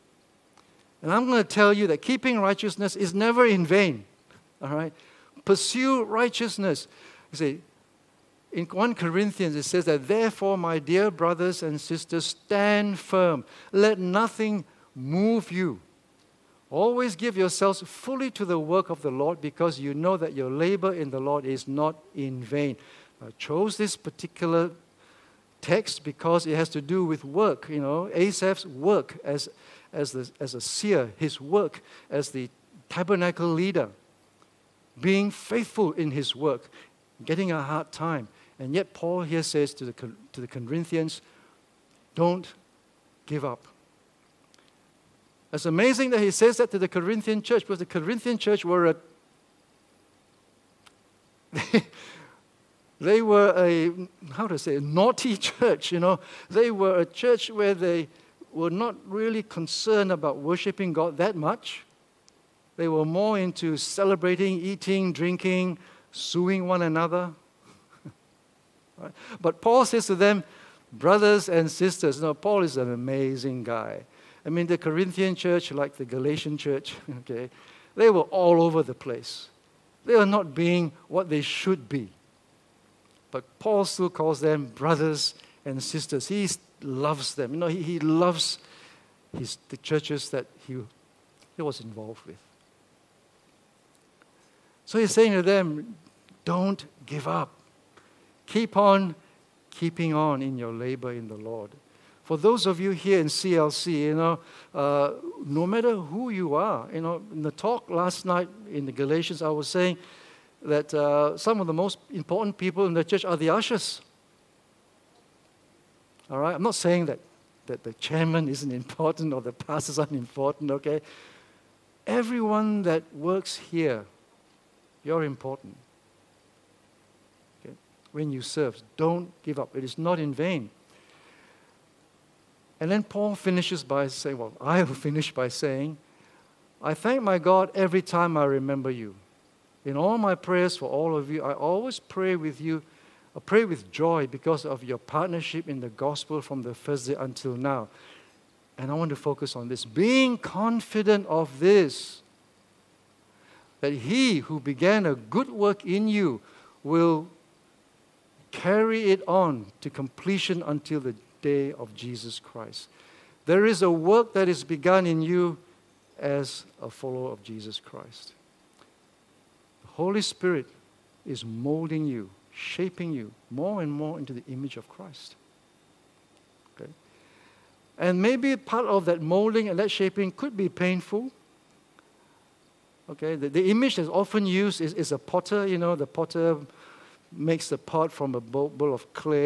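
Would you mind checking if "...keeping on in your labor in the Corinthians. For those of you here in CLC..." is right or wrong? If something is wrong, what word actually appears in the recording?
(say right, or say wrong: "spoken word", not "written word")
wrong: "Lord", not "Corinthians".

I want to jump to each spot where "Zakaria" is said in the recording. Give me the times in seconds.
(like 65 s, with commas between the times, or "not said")
not said.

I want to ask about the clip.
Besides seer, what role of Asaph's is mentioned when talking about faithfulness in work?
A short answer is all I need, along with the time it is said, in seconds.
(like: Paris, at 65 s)
Tabernacle leader, at 32 s.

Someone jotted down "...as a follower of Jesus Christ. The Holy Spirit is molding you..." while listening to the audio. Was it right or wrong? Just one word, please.
right.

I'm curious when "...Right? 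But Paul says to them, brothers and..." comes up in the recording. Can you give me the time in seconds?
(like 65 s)
68 s.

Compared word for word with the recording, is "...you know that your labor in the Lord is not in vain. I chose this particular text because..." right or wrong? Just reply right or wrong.
right.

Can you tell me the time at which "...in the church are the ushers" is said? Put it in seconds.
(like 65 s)
112 s.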